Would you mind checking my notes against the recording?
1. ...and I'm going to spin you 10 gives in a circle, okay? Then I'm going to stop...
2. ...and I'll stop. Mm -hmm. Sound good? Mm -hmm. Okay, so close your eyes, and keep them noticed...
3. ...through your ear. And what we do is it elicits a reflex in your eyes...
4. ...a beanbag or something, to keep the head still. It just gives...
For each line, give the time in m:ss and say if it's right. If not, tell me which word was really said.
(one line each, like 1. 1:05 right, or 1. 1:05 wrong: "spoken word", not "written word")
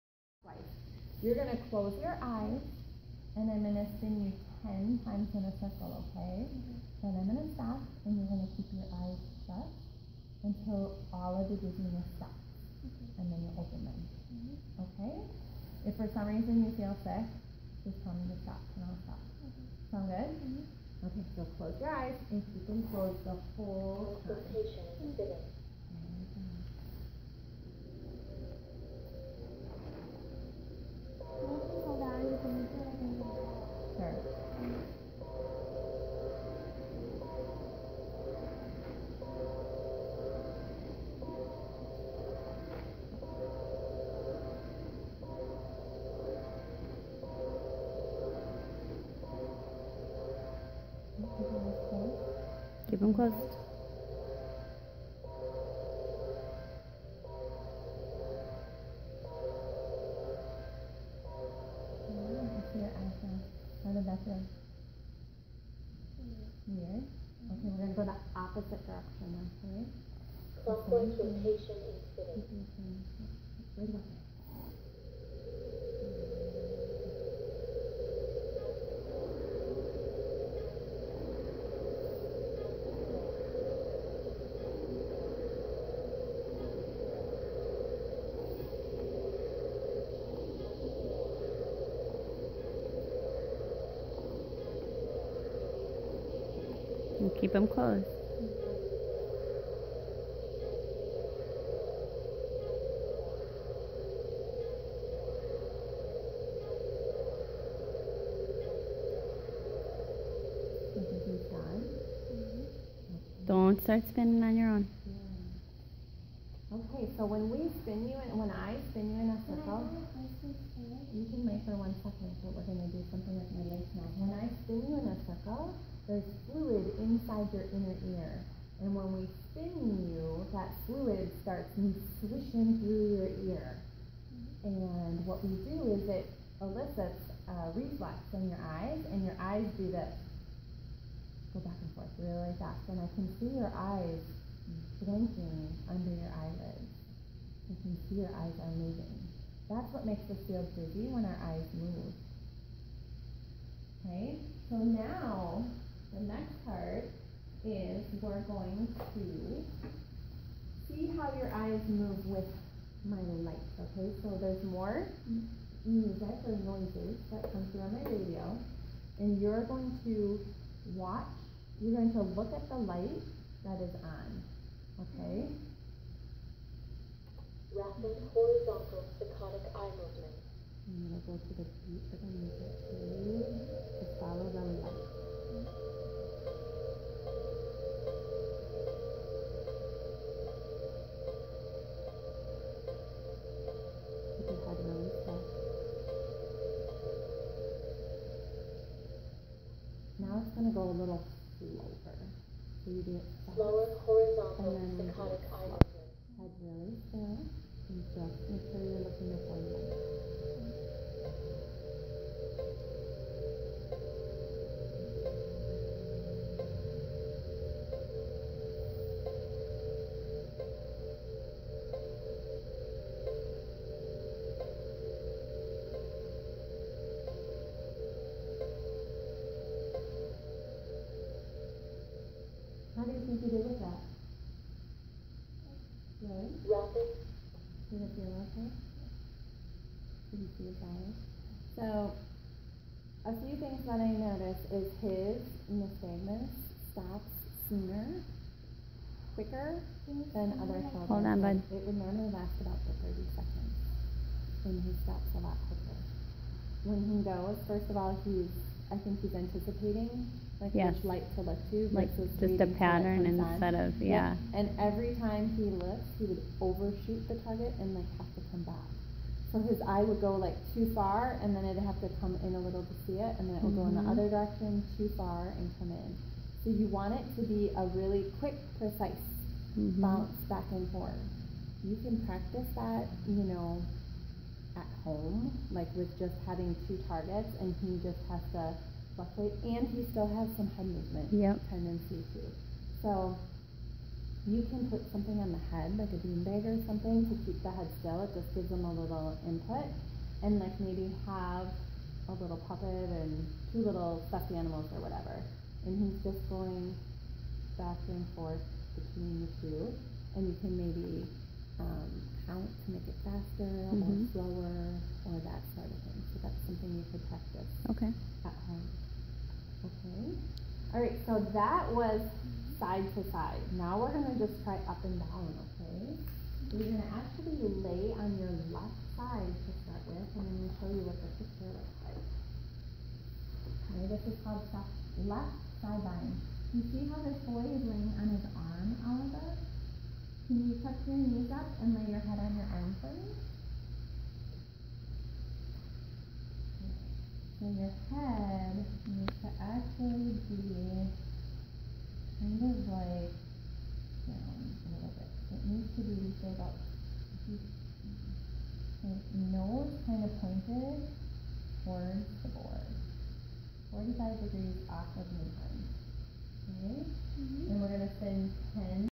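1. 0:03 wrong: "times", not "gives"
2. 0:18 wrong: "closed", not "noticed"
3. 2:12 right
4. 4:56 right.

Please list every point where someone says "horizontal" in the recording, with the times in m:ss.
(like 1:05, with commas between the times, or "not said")
2:58, 3:24.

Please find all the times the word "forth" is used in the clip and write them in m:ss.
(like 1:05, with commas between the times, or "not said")
2:21, 4:40, 5:08.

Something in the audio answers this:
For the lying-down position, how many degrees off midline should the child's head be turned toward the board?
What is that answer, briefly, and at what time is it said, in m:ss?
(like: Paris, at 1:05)
45 degrees, at 6:03.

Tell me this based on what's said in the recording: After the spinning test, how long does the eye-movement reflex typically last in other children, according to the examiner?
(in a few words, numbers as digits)
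30 seconds.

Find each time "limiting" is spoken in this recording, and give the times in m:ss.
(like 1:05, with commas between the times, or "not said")
not said.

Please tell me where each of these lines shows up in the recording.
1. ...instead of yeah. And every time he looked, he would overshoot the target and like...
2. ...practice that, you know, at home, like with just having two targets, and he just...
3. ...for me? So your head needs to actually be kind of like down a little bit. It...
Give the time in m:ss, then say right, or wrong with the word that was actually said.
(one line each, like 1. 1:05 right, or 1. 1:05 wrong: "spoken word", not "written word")
1. 4:23 right
2. 4:42 right
3. 5:43 right.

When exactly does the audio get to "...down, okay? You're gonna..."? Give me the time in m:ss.
5:25.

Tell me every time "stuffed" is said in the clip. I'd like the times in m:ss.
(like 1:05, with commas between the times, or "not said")
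5:04.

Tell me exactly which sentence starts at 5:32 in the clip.
Okay, this is called left side bind.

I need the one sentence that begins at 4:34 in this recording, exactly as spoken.
other direction too far and come in.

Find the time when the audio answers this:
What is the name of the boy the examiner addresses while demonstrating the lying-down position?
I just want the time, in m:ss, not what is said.
5:39.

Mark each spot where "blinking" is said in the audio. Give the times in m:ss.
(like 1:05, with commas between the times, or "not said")
2:25.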